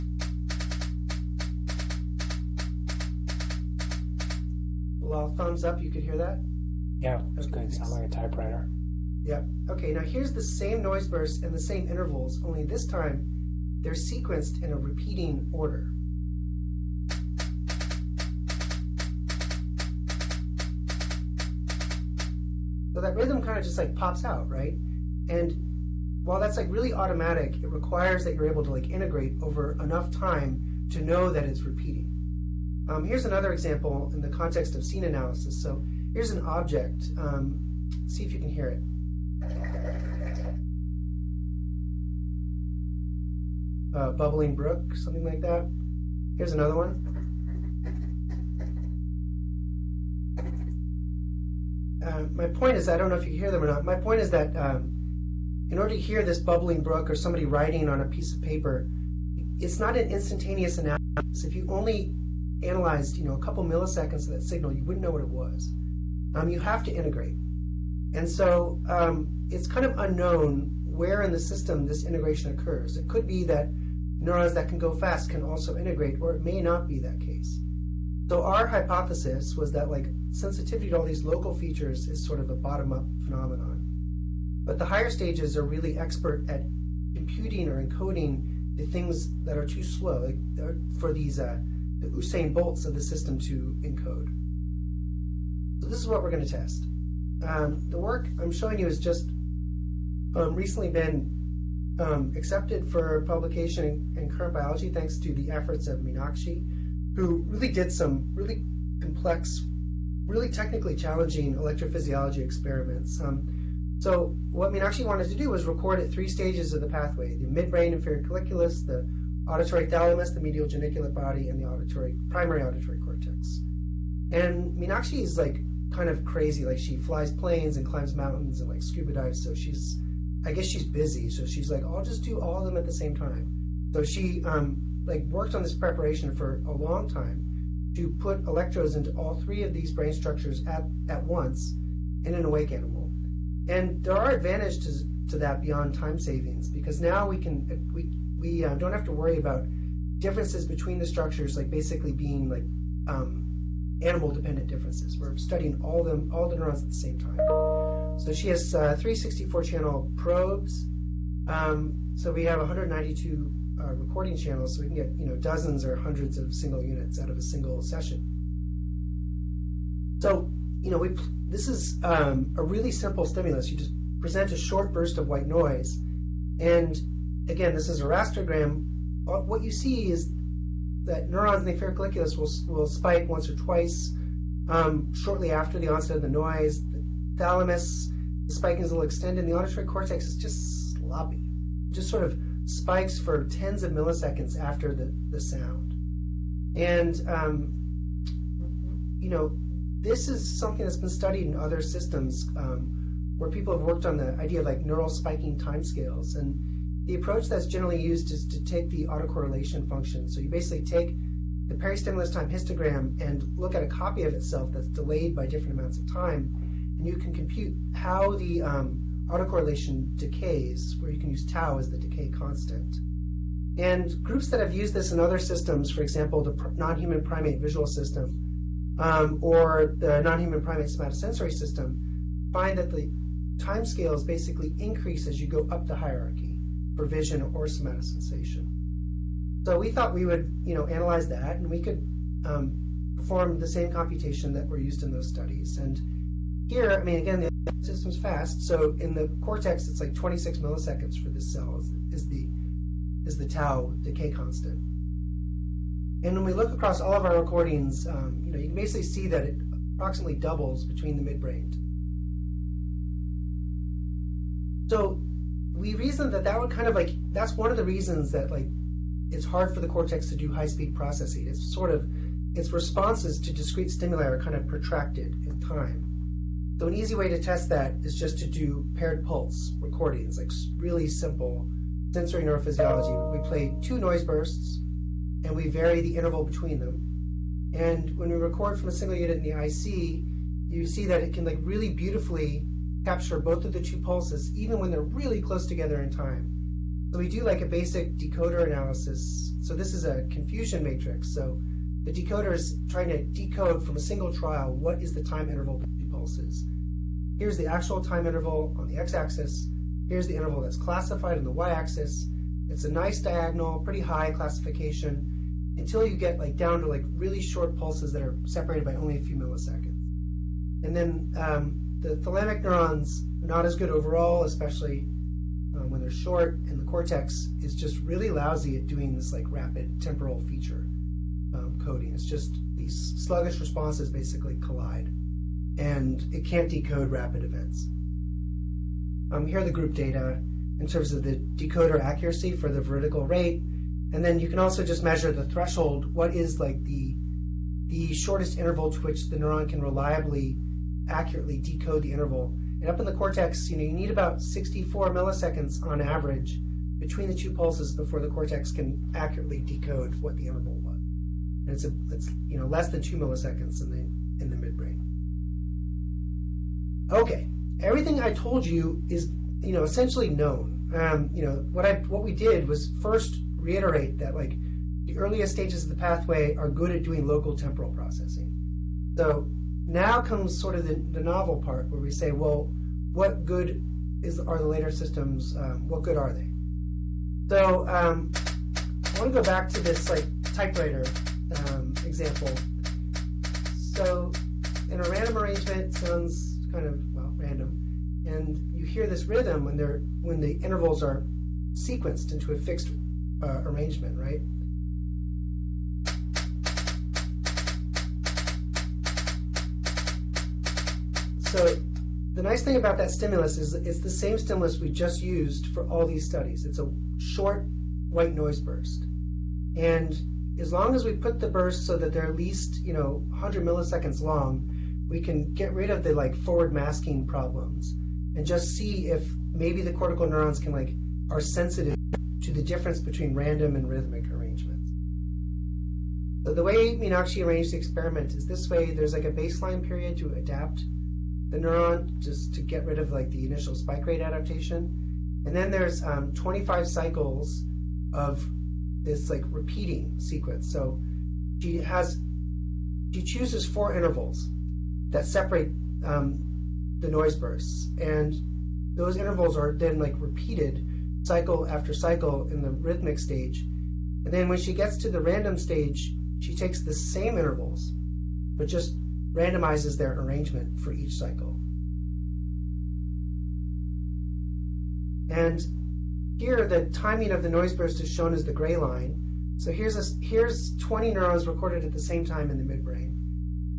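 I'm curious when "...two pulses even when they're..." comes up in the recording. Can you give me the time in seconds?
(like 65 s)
293 s.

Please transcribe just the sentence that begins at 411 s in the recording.
So the nice thing about that stimulus is it's the same stimulus we just used for all these studies.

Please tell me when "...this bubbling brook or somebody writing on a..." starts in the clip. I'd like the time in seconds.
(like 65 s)
56 s.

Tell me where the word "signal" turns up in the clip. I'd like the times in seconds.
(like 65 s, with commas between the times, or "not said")
64 s.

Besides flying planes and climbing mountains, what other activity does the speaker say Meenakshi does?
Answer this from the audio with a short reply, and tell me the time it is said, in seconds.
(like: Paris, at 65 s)
Scuba dives, at 128 s.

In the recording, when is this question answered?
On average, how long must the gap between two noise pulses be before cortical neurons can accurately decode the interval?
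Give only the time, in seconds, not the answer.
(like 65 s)
354 s.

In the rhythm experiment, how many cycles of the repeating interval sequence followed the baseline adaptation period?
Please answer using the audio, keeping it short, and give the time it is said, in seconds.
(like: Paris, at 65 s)
25, at 446 s.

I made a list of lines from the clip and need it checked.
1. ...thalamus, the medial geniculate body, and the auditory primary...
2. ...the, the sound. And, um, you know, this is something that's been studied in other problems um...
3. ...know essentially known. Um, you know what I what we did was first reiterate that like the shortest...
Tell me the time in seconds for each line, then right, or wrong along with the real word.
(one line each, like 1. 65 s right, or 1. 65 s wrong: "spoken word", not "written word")
1. 119 s right
2. 194 s wrong: "systems", not "problems"
3. 369 s wrong: "earliest", not "shortest".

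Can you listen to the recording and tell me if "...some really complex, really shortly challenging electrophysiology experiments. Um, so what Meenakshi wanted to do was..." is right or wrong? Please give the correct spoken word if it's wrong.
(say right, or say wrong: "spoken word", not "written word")
wrong: "technically", not "shortly".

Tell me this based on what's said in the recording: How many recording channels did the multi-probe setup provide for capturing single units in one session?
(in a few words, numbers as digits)
192.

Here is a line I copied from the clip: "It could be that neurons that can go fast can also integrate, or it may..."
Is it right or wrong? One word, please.
right.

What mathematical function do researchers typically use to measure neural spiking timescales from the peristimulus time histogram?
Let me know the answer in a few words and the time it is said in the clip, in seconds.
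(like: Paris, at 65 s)
Autocorrelation function, at 209 s.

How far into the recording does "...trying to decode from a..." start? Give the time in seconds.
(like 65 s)
302 s.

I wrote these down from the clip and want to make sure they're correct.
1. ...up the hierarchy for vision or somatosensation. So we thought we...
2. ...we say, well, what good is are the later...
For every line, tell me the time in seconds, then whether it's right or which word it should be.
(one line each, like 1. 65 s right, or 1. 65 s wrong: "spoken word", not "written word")
1. 235 s right
2. 382 s right.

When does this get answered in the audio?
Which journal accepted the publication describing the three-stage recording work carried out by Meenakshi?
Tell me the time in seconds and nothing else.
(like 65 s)
104 s.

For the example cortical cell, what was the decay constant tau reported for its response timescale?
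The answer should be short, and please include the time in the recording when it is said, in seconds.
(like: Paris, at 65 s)
26 milliseconds, at 250 s.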